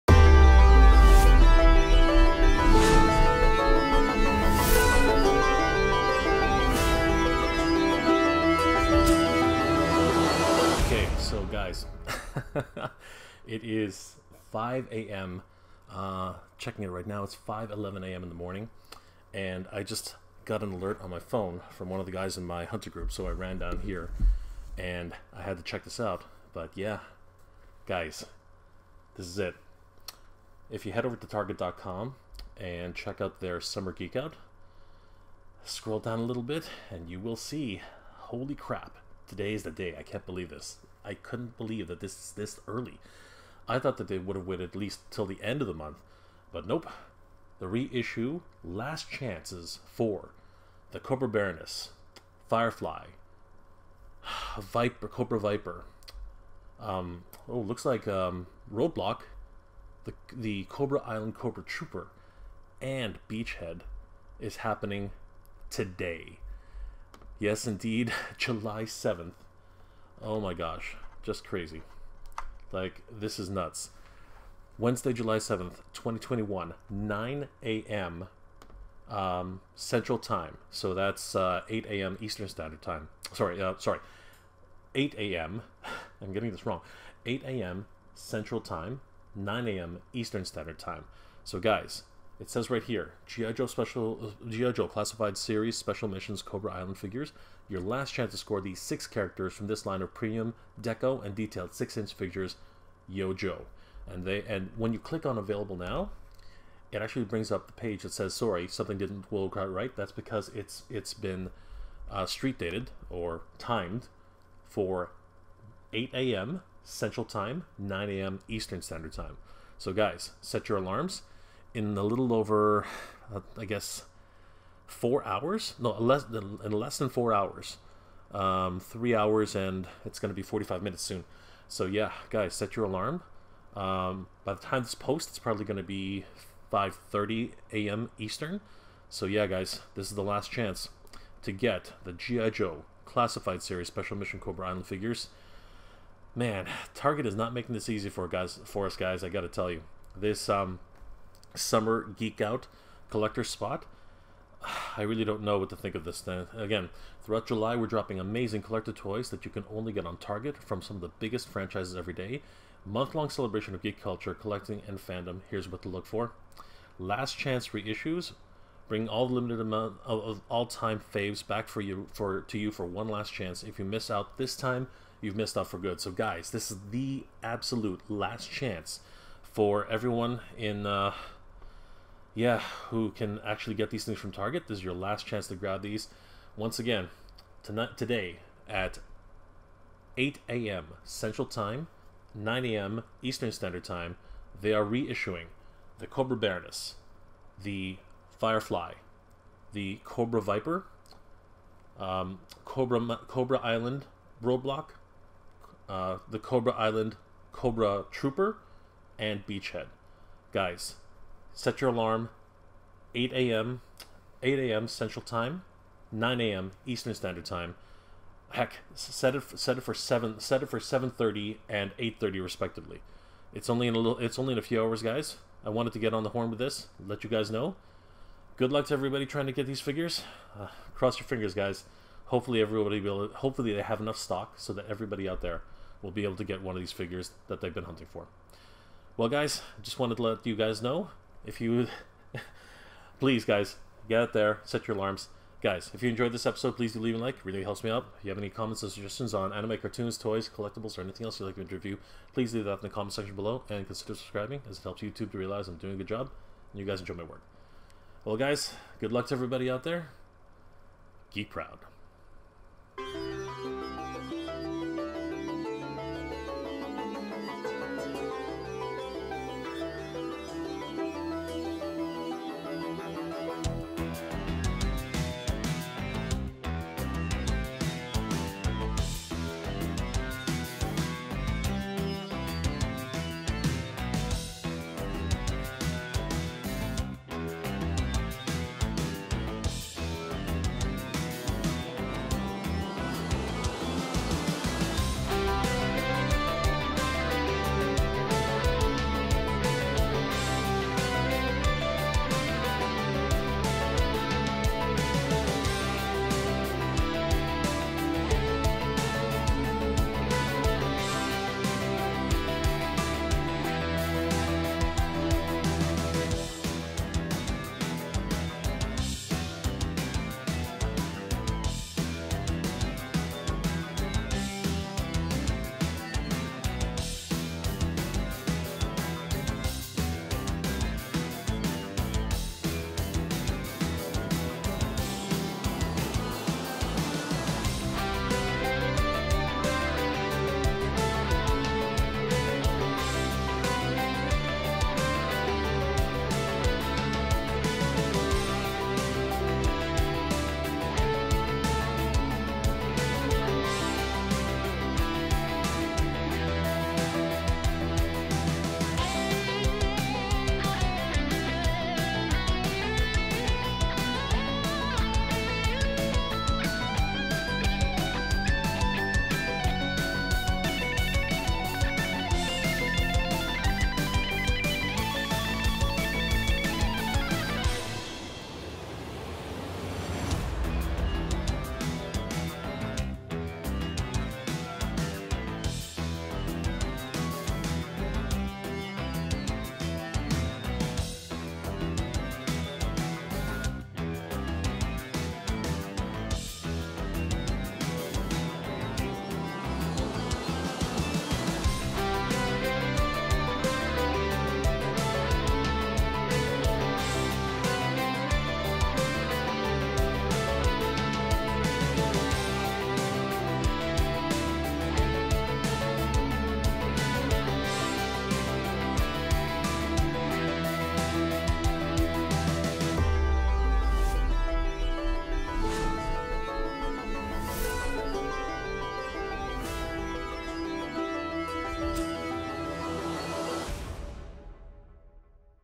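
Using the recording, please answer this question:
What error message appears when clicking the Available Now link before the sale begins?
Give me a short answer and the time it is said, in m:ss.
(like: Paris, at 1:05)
Sorry, something didn't work out right, at 1:48.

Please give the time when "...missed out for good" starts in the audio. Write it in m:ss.
2:55.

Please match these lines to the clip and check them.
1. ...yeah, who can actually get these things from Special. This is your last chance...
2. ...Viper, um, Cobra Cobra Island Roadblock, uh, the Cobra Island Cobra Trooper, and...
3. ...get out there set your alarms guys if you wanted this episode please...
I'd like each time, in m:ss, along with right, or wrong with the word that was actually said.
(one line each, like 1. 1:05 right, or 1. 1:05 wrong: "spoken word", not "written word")
1. 3:02 wrong: "Target", not "Special"
2. 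3:20 right
3. 4:04 wrong: "enjoyed", not "wanted".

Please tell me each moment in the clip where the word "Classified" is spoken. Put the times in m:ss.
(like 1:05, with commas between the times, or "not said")
1:34, 2:23.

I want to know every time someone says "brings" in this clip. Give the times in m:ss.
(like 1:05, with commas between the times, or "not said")
1:47, 2:48.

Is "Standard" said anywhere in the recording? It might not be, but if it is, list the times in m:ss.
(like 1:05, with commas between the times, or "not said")
1:22, 1:30, 1:58, 3:13, 3:37.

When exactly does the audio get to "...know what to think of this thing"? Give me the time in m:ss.
2:35.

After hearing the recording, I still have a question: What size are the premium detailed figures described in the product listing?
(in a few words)
six-inch.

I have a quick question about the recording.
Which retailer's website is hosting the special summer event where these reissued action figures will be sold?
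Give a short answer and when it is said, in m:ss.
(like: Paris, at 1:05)
Target.com, at 0:31.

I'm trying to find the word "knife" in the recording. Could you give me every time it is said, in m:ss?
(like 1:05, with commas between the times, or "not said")
not said.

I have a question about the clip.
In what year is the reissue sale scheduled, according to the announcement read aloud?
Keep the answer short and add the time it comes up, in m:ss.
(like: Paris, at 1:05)
2021, at 1:15.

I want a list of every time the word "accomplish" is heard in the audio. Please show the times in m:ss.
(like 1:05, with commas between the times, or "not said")
not said.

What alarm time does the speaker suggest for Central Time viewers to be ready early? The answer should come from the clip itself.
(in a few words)
7:30.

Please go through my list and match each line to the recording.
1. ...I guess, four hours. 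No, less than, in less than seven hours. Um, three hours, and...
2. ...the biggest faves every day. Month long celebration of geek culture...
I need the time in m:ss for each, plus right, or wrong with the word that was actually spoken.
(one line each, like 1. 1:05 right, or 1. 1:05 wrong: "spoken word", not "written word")
1. 2:03 wrong: "four", not "seven"
2. 2:41 wrong: "franchises", not "faves".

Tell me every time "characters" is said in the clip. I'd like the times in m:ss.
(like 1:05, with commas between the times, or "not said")
1:39.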